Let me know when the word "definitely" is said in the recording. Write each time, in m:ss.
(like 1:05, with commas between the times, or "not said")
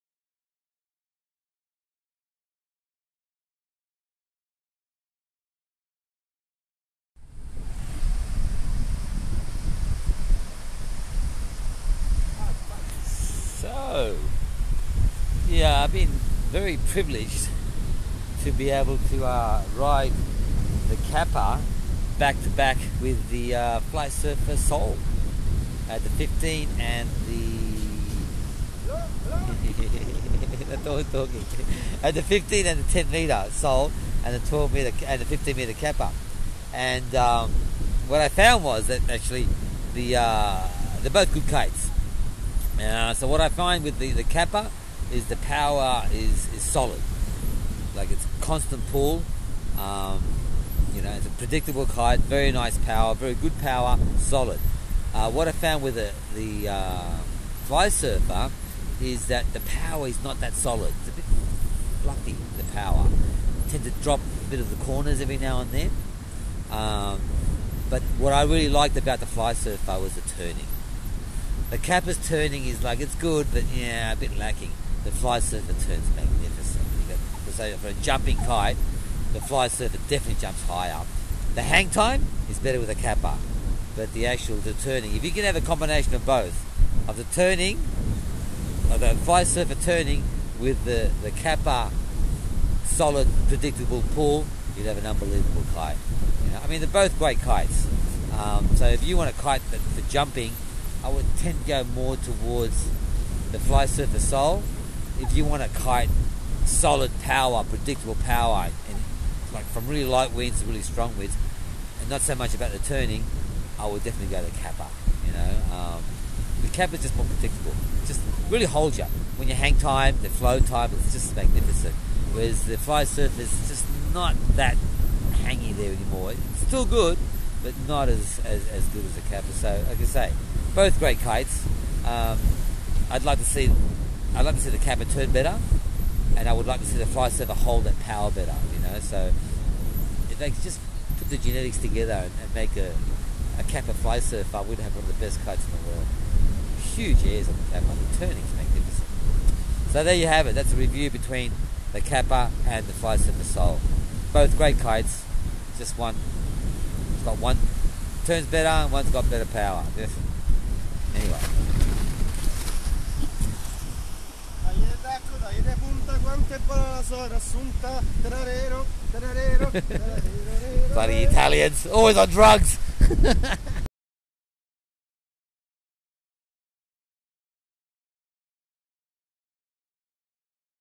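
1:20, 1:54, 2:39.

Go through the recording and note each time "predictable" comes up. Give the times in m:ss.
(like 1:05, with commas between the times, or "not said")
0:51, 1:33, 1:47, 1:57.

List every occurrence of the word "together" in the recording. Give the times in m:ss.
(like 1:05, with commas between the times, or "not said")
2:21.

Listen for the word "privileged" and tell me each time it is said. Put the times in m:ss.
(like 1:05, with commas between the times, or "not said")
0:16.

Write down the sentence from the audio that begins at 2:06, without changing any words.
It's still good, but not as, as, as good as the Capa.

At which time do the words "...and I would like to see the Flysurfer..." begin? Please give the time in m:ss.
2:16.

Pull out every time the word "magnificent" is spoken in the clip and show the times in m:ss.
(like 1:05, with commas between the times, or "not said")
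1:16, 2:01, 2:28.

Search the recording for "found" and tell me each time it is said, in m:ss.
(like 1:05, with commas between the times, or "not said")
0:38, 0:55.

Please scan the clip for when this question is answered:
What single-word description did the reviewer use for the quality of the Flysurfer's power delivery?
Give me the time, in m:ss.
1:02.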